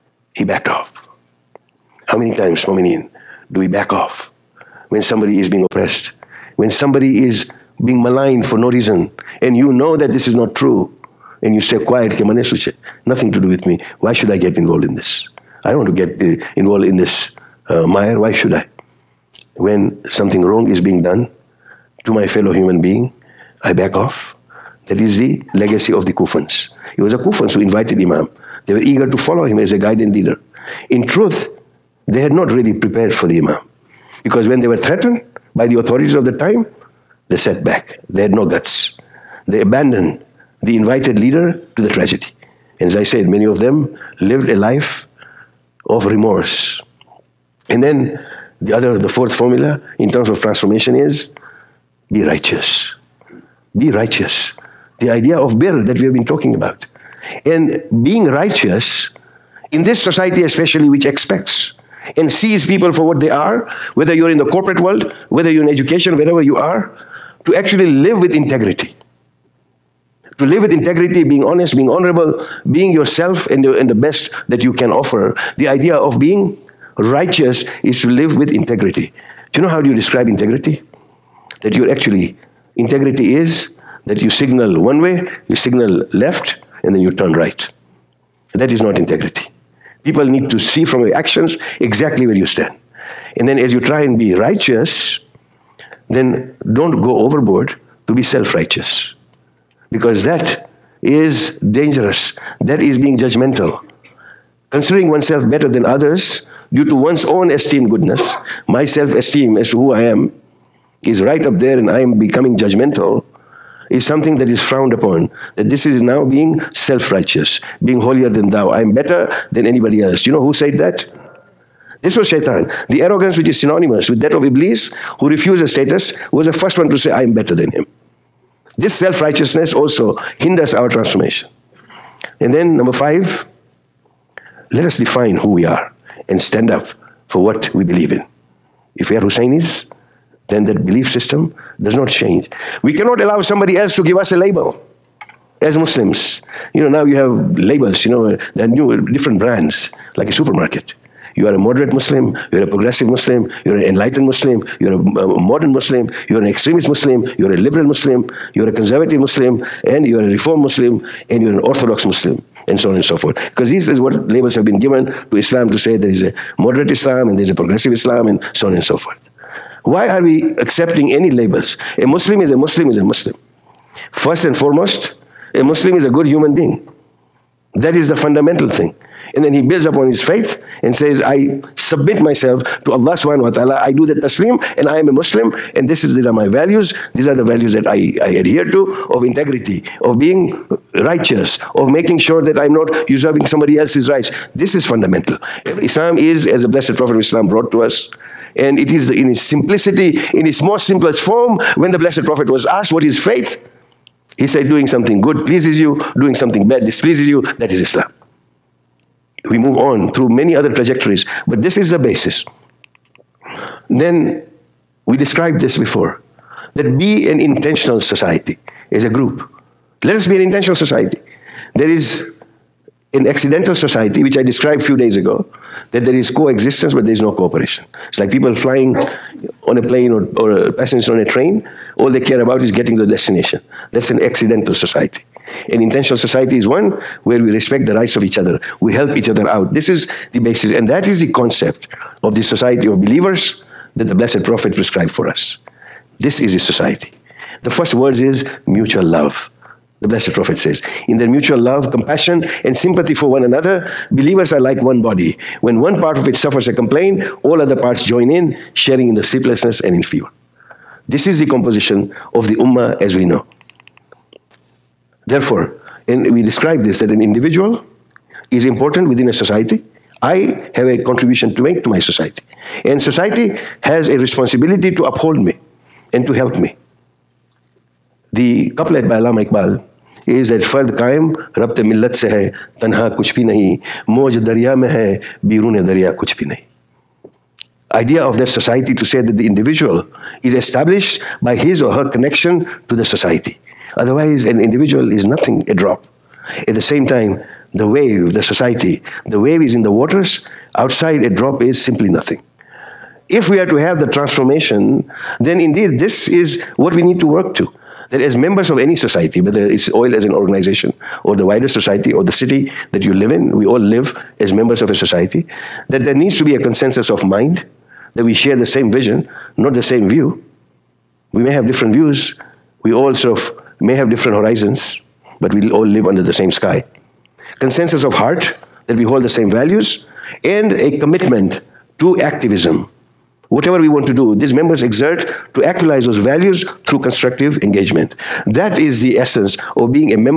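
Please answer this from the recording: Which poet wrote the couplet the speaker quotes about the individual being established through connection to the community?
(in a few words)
Allama Iqbal.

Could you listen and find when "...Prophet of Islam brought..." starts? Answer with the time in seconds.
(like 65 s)
196 s.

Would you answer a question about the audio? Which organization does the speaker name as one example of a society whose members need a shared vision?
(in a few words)
OIL.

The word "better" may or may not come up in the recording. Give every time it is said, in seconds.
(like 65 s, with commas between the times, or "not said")
105 s, 118 s, 127 s.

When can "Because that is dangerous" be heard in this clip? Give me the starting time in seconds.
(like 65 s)
99 s.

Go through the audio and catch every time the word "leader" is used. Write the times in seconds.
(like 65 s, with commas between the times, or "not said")
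30 s, 41 s.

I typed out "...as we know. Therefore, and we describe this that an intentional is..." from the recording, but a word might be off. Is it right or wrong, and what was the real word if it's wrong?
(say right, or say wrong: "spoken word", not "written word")
wrong: "individual", not "intentional".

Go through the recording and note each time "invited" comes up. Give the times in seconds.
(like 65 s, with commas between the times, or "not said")
27 s, 40 s.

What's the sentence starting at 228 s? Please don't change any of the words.
It's like people flying on a plane or, or passengers on a train, all they care about is getting to the destination.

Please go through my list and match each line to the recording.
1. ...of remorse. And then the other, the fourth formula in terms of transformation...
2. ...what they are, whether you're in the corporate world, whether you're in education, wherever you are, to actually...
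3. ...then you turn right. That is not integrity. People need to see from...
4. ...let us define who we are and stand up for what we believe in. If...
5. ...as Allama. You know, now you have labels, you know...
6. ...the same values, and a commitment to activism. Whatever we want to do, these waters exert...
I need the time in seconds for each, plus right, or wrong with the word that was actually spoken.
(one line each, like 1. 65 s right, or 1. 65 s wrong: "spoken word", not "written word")
1. 45 s right
2. 63 s right
3. 86 s right
4. 134 s right
5. 145 s wrong: "Muslims", not "Allama"
6. 329 s wrong: "members", not "waters".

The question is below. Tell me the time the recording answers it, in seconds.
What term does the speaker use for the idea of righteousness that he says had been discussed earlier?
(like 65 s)
55 s.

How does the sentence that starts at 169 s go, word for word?
Why are we accepting any labels?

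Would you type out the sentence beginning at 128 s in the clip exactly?
This self righteousness also hinders our transformation.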